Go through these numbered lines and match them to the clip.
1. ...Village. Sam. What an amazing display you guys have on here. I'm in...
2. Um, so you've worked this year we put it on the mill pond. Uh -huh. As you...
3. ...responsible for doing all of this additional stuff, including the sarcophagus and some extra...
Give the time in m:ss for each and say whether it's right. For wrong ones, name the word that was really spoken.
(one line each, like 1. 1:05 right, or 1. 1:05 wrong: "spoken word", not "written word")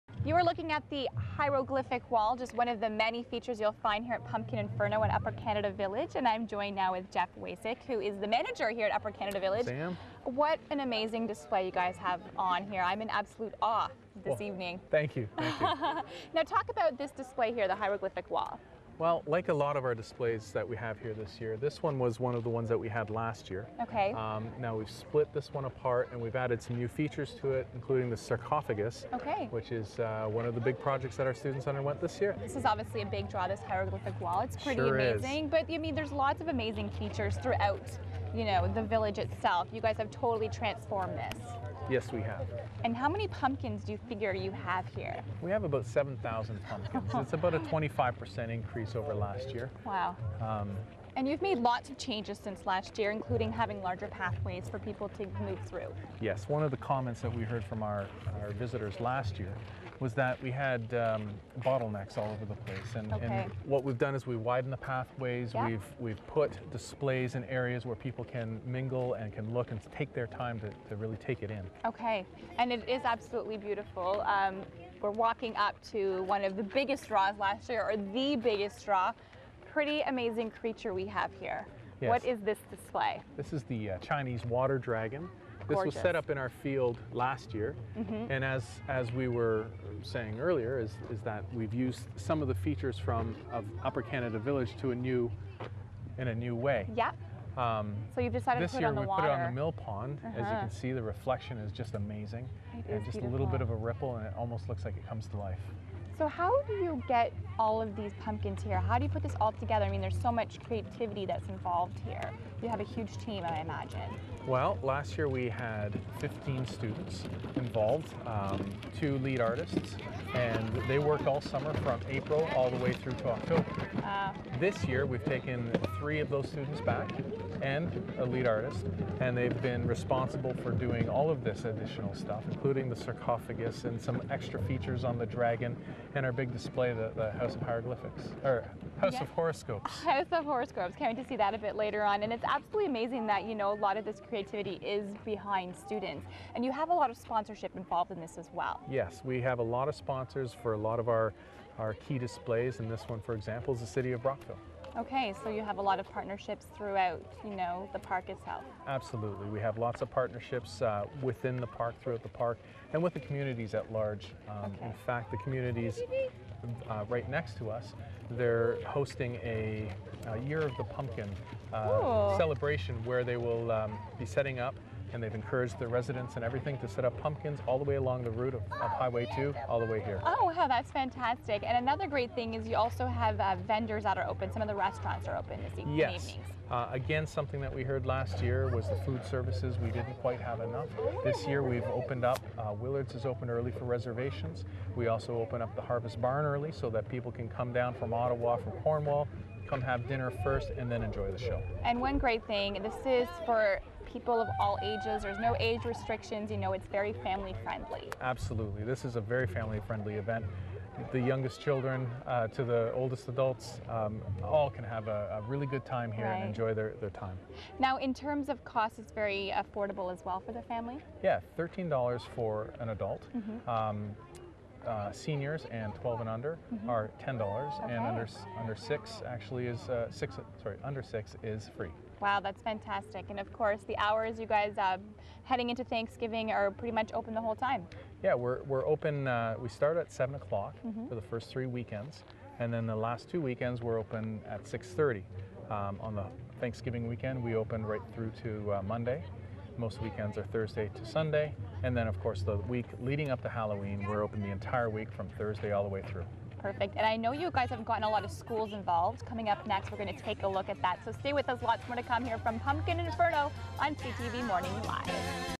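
1. 0:09 right
2. 1:37 wrong: "decided", not "worked"
3. 2:09 right.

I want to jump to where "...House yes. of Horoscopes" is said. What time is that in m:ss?
2:18.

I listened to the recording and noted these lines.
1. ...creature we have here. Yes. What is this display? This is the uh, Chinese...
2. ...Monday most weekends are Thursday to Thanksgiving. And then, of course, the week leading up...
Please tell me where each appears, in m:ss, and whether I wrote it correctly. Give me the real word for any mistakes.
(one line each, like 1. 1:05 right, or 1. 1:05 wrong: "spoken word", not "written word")
1. 1:20 right
2. 4:08 wrong: "Sunday", not "Thanksgiving".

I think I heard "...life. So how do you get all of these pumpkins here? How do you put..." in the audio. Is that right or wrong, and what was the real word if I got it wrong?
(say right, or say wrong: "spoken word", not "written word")
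right.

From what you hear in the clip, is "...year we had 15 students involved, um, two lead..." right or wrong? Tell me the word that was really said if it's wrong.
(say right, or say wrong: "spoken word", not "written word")
right.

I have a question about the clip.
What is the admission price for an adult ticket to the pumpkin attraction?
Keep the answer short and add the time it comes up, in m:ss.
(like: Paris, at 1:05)
$13, at 3:41.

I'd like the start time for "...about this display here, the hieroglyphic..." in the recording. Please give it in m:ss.
0:16.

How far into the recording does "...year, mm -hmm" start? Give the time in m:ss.
1:27.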